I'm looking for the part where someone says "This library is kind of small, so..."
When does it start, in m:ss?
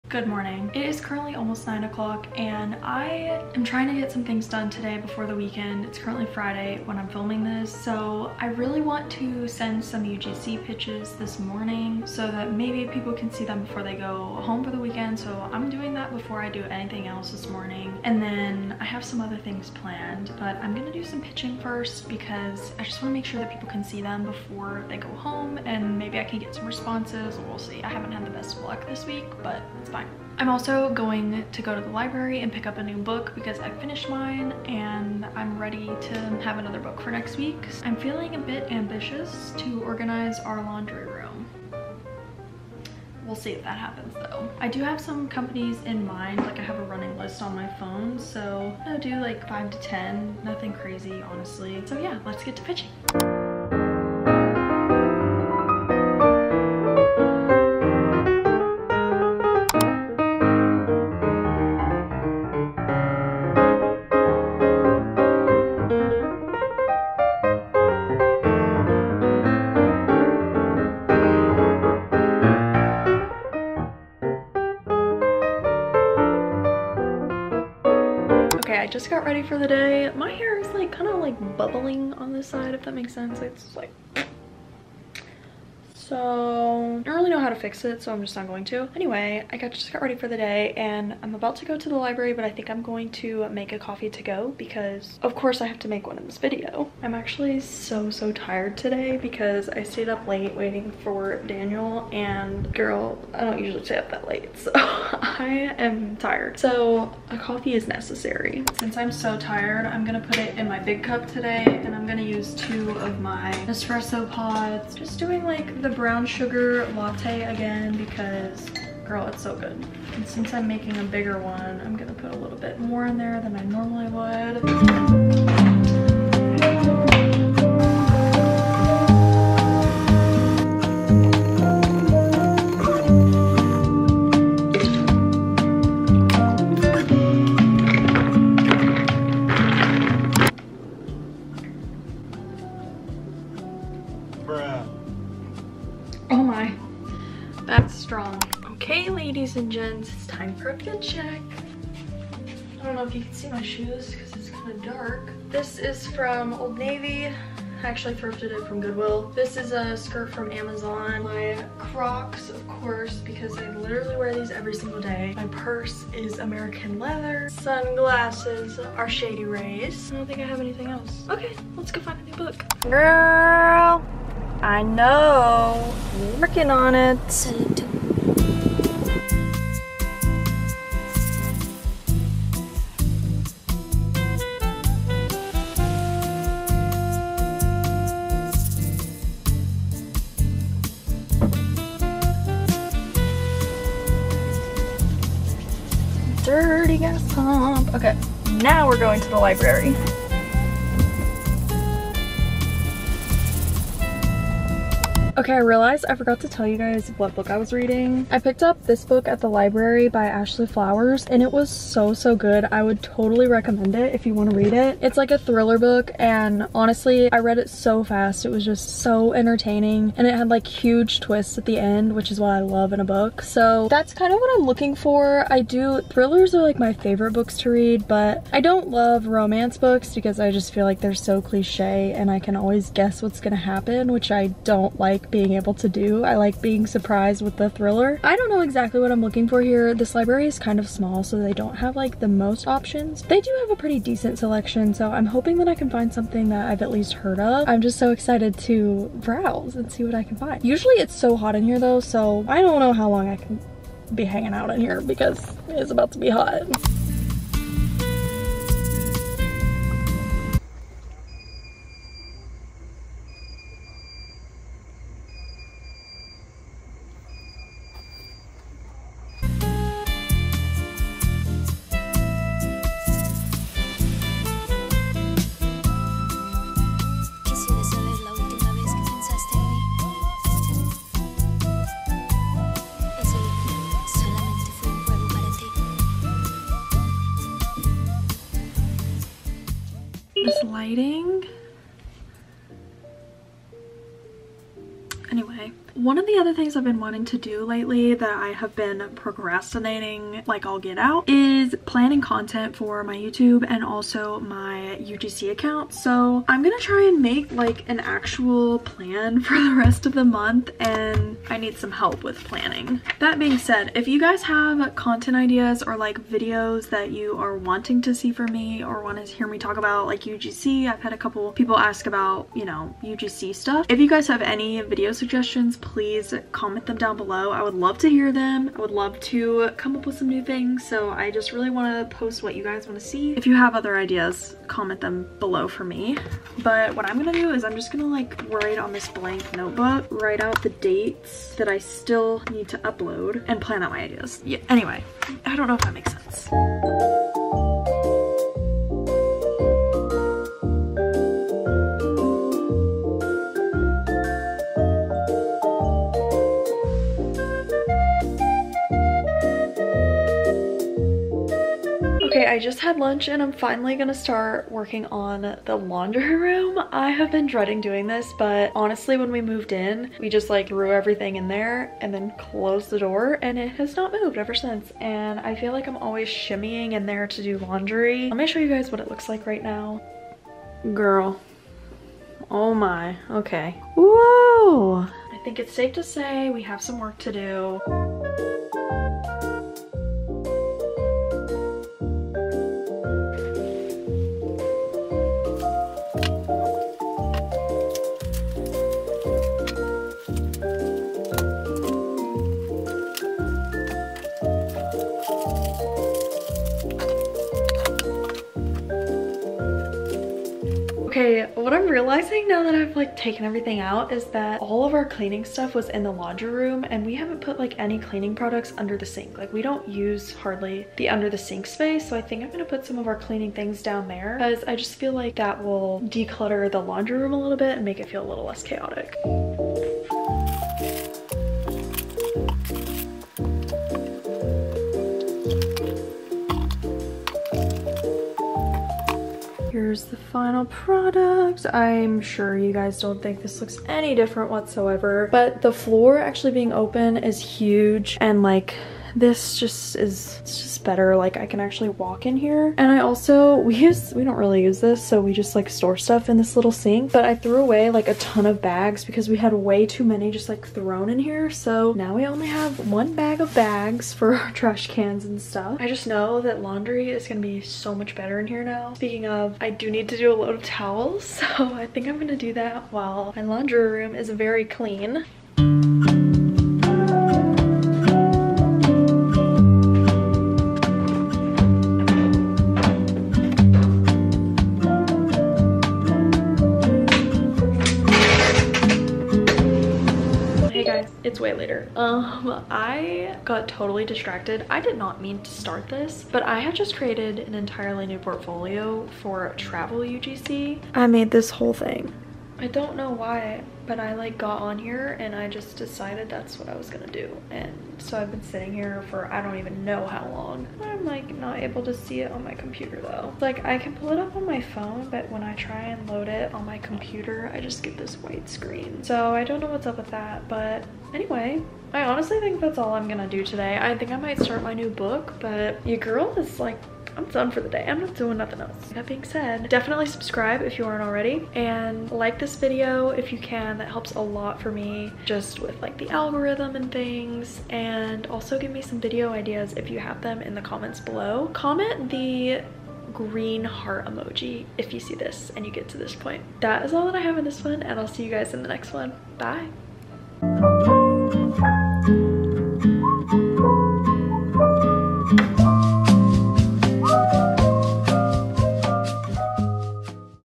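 3:59.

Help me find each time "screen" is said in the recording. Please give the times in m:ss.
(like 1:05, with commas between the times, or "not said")
8:38.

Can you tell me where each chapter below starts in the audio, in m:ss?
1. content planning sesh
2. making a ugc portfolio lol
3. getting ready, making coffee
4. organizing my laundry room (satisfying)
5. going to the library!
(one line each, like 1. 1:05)
1. 4:50
2. 8:10
3. 1:18
4. 6:02
5. 2:52.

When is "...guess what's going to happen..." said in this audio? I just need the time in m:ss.
3:52.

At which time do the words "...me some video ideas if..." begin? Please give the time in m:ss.
8:58.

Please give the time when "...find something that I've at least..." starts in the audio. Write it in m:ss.
4:05.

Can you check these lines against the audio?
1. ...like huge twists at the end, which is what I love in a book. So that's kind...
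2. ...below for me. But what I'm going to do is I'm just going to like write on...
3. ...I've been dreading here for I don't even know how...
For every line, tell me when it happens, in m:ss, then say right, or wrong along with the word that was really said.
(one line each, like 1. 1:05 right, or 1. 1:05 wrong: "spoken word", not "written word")
1. 3:40 right
2. 5:35 right
3. 8:28 wrong: "sitting", not "dreading".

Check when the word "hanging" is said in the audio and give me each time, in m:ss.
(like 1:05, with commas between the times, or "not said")
4:14.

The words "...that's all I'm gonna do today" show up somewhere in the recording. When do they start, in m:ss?
8:42.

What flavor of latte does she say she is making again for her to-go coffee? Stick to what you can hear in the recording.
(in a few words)
brown sugar.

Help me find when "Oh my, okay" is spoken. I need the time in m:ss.
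6:22.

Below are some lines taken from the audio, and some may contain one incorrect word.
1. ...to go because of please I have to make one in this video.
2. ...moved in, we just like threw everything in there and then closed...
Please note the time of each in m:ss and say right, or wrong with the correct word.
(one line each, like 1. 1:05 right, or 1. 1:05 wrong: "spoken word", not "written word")
1. 1:34 wrong: "course", not "please"
2. 6:09 right.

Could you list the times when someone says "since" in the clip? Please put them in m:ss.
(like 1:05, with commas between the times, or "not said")
1:48, 2:00, 6:14.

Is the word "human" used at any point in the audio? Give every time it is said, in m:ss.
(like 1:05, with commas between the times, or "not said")
not said.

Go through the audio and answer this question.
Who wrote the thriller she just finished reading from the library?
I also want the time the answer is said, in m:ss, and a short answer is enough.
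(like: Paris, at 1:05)
Ashley Flowers, at 3:30.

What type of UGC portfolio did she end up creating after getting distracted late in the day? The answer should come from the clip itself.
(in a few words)
travel UGC.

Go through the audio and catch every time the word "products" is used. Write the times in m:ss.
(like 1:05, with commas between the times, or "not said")
6:58, 7:20.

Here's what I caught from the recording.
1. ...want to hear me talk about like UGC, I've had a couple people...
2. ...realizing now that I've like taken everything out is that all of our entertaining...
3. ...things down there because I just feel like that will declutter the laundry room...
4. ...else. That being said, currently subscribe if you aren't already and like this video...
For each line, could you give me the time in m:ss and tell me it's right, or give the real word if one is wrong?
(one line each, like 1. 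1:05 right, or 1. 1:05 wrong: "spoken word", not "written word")
1. 5:19 right
2. 6:51 wrong: "cleaning", not "entertaining"
3. 7:03 right
4. 8:48 wrong: "definitely", not "currently".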